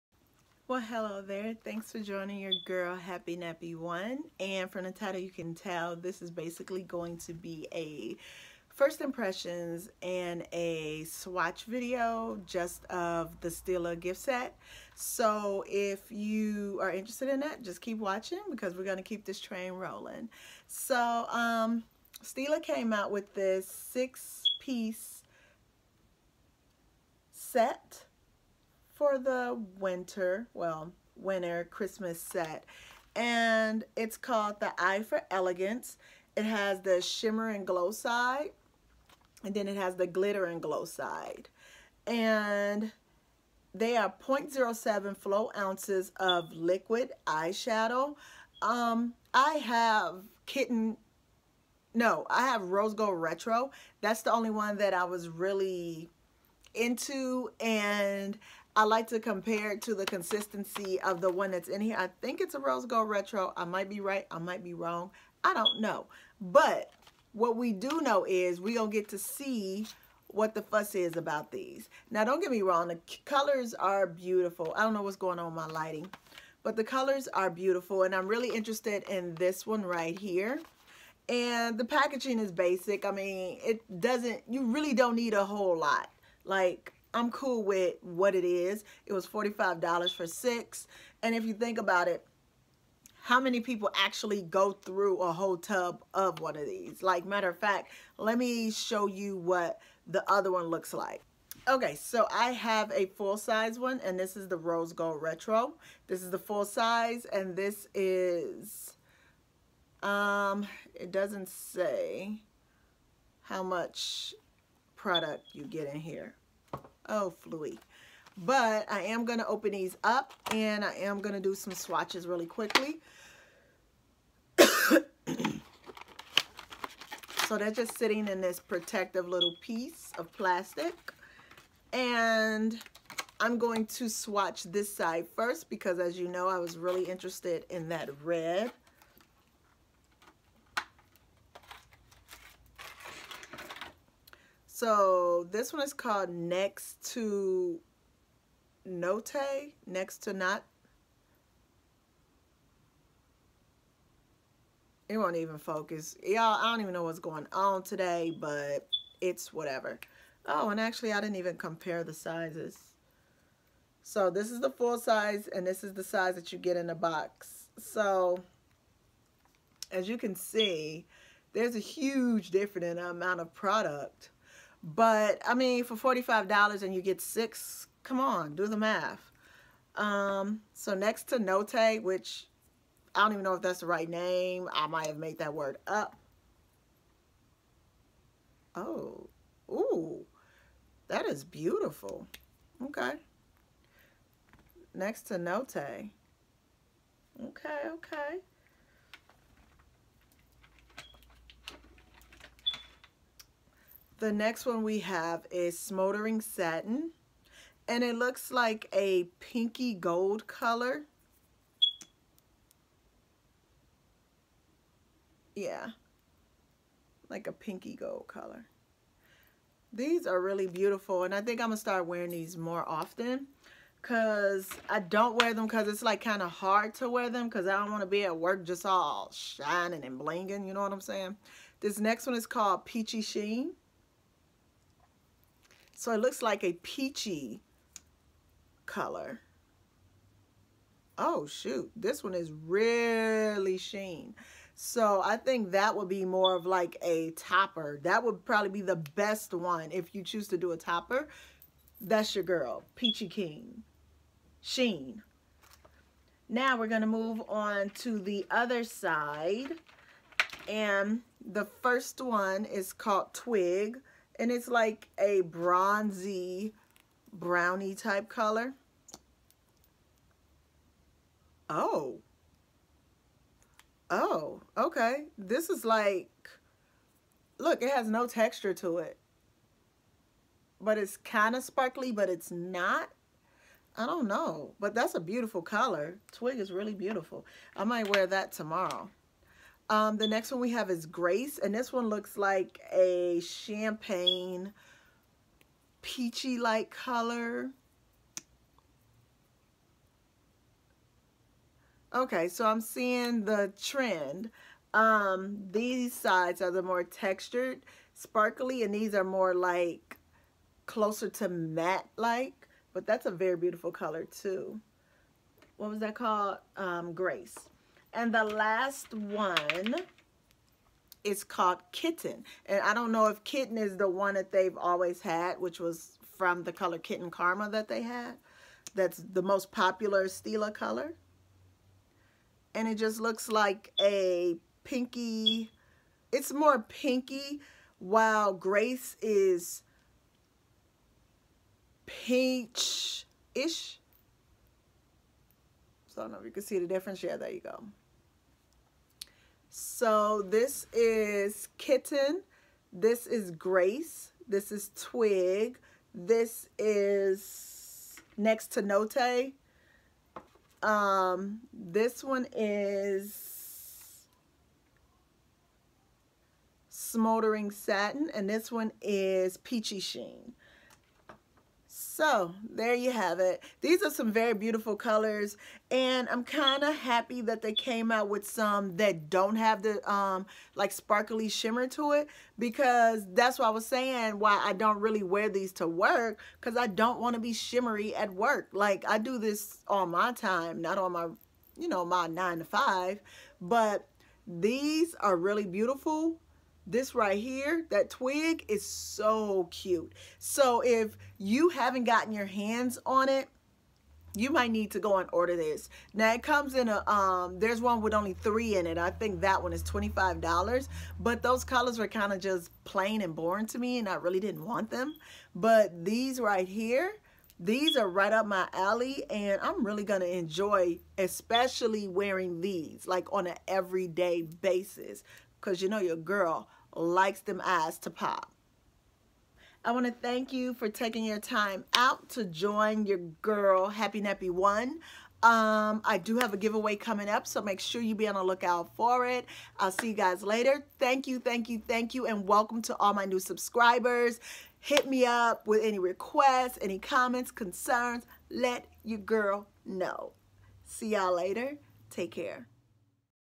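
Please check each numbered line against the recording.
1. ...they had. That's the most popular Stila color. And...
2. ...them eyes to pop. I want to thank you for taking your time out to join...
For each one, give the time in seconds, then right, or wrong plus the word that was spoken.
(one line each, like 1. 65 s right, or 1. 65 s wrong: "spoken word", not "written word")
1. 327 s right
2. 427 s right.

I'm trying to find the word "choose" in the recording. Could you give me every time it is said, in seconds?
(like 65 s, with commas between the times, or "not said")
250 s.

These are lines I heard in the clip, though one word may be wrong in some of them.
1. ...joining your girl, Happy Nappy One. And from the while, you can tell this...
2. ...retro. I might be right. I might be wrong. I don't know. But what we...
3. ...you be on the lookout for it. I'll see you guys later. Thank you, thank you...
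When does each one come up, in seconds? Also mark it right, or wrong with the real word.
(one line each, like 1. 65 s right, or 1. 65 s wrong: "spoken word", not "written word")
1. 1 s wrong: "title", not "while"
2. 63 s right
3. 438 s right.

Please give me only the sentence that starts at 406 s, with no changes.
Now it comes in a, um, there's one with only three in it.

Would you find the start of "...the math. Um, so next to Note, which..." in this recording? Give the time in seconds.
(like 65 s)
178 s.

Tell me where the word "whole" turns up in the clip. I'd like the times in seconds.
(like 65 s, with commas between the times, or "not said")
85 s, 95 s.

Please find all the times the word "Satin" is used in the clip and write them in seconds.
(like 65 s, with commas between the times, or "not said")
206 s, 367 s.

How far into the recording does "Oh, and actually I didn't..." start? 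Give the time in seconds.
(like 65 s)
160 s.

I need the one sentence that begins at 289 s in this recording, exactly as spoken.
Um, the next one we have is Grace, and this one looks like a champagne peachy-like color.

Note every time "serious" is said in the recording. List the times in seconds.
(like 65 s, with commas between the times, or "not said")
not said.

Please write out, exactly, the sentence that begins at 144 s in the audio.
So this one is called Next to Note, Next to Not.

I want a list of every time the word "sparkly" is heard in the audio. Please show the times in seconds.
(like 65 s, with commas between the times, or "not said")
281 s, 308 s, 380 s.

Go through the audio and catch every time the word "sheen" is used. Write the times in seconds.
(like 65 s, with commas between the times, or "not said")
233 s, 243 s, 254 s, 370 s.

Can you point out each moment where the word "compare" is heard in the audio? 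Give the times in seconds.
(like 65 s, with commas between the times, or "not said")
59 s, 161 s.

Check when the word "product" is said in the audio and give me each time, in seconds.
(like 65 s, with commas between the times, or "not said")
115 s, 173 s.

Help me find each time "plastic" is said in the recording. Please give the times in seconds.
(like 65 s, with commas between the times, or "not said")
130 s.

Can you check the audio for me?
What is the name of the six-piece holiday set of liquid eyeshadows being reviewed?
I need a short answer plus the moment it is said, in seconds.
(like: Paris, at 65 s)
Eye for Elegance, at 34 s.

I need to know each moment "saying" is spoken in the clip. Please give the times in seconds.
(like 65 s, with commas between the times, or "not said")
231 s, 383 s.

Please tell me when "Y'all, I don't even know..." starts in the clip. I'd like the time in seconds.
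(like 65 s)
156 s.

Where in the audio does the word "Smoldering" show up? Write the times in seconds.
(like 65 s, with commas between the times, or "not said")
205 s, 366 s.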